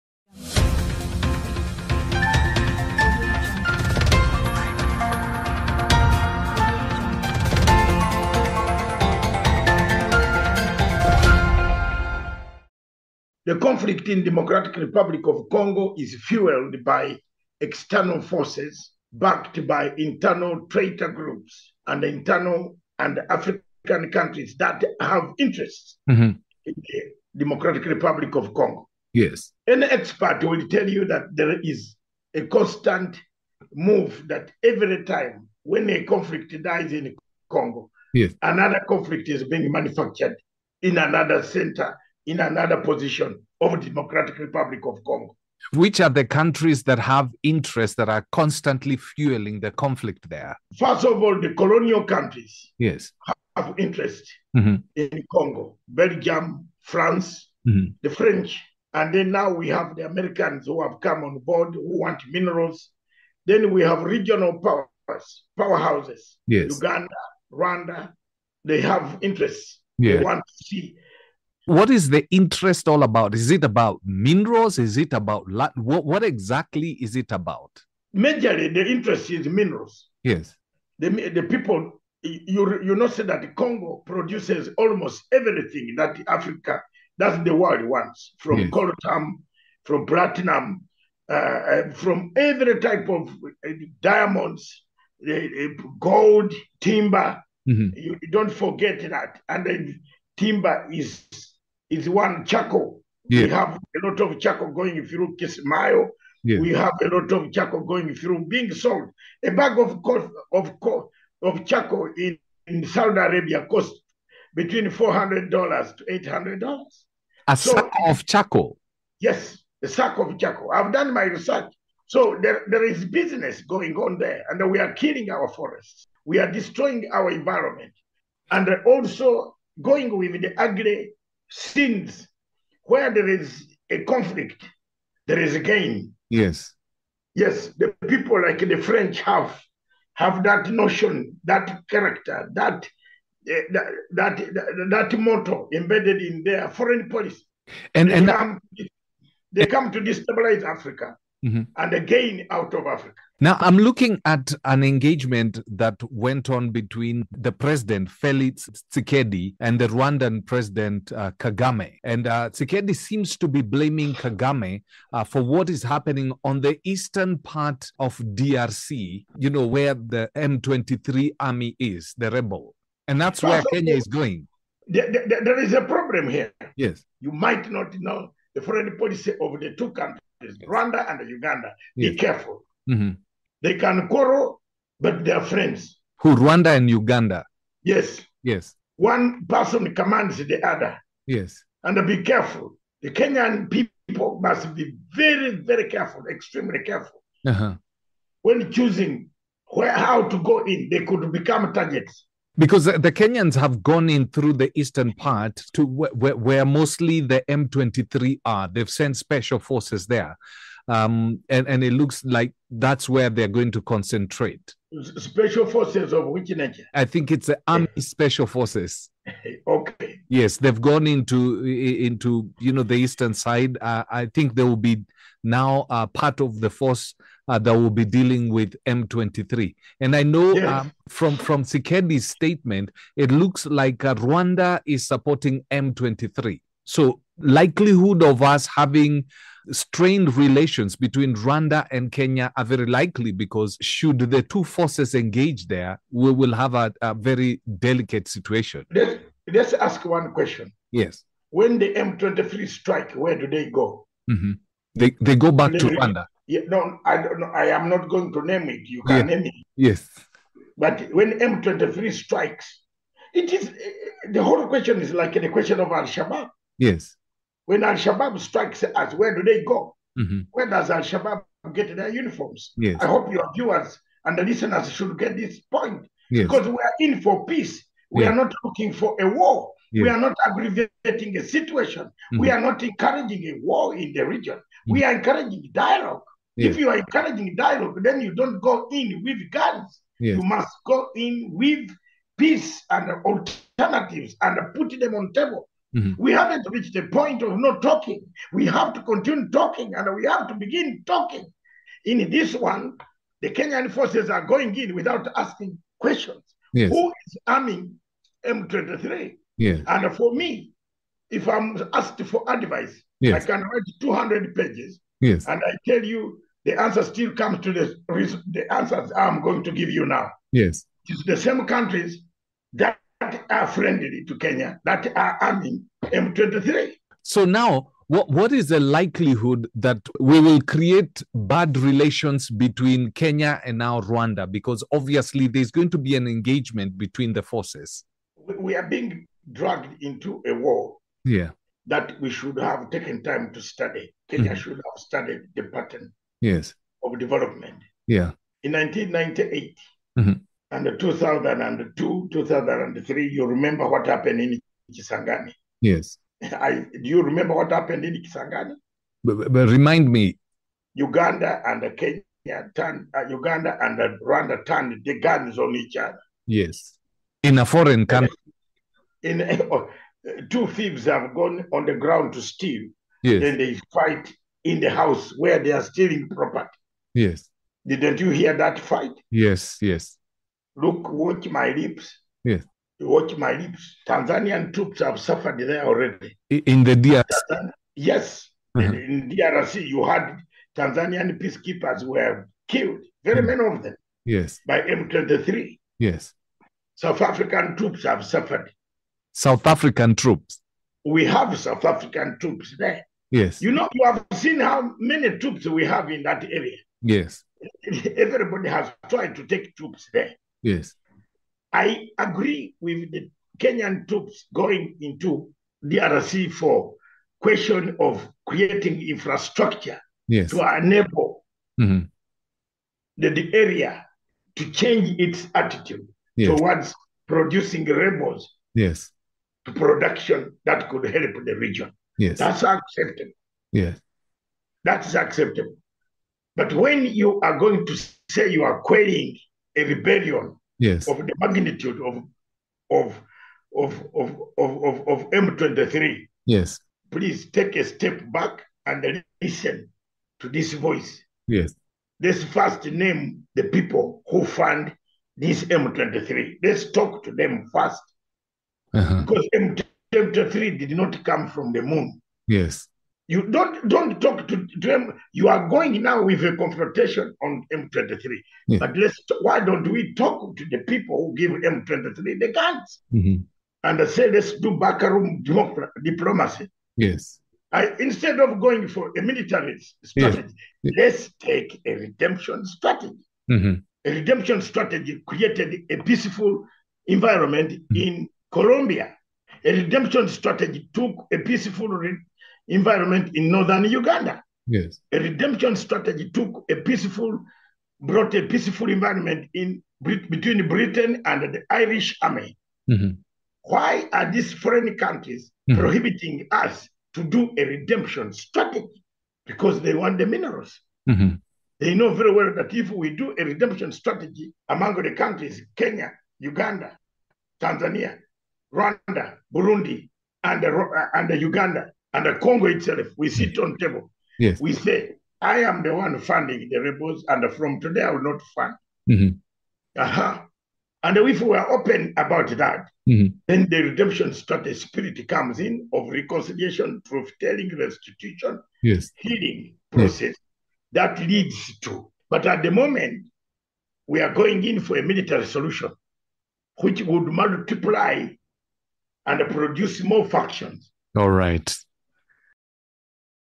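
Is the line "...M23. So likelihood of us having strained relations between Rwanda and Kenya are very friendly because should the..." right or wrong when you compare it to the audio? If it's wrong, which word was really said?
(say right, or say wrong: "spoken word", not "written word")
wrong: "likely", not "friendly".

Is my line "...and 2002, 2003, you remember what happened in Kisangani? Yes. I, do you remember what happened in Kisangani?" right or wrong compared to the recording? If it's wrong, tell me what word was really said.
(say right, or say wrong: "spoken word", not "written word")
right.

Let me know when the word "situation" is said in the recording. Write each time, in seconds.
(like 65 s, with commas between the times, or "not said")
248 s, 281 s.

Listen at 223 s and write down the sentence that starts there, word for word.
Uh, I think they will be now uh, part of the force uh, that will be dealing with M23.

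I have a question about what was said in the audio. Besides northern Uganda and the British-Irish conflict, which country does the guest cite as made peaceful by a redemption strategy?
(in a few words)
Colombia.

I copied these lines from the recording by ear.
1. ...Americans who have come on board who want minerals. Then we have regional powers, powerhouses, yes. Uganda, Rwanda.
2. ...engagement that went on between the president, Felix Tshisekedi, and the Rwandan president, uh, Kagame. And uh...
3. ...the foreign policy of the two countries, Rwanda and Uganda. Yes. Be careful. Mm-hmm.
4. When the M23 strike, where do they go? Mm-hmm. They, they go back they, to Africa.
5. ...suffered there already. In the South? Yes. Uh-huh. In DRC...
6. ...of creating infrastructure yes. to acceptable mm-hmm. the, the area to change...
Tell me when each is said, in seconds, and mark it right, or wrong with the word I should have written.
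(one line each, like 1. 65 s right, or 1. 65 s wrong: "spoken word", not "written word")
1. 60 s right
2. 154 s right
3. 178 s right
4. 251 s wrong: "Rwanda", not "Africa"
5. 385 s wrong: "DRC", not "South"
6. 417 s wrong: "enable", not "acceptable".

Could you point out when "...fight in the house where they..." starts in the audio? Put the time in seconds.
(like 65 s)
373 s.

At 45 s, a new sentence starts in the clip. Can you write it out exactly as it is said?
Which are the countries that have interests that are constantly fueling the conflict there?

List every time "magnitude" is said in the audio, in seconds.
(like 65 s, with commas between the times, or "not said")
441 s.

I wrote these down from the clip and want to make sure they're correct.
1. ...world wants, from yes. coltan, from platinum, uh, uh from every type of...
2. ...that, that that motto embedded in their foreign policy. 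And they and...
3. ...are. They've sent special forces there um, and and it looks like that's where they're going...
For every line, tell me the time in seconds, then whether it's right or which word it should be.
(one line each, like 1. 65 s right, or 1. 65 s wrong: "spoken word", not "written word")
1. 87 s right
2. 143 s right
3. 208 s right.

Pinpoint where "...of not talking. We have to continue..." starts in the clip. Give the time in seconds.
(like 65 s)
297 s.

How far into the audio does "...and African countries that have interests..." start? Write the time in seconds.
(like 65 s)
22 s.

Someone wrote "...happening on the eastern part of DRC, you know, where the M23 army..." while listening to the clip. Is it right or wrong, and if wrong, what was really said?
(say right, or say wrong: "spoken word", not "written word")
right.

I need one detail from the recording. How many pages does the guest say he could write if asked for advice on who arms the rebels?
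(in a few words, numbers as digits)
200.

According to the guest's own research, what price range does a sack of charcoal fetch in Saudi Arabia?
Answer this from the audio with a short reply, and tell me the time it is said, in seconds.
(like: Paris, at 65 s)
$400 to $800, at 114 s.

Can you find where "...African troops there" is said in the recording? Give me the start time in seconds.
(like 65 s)
401 s.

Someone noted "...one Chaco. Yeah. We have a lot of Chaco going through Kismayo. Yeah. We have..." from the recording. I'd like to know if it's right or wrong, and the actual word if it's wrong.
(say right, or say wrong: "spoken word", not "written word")
right.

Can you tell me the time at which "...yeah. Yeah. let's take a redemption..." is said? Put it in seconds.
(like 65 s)
480 s.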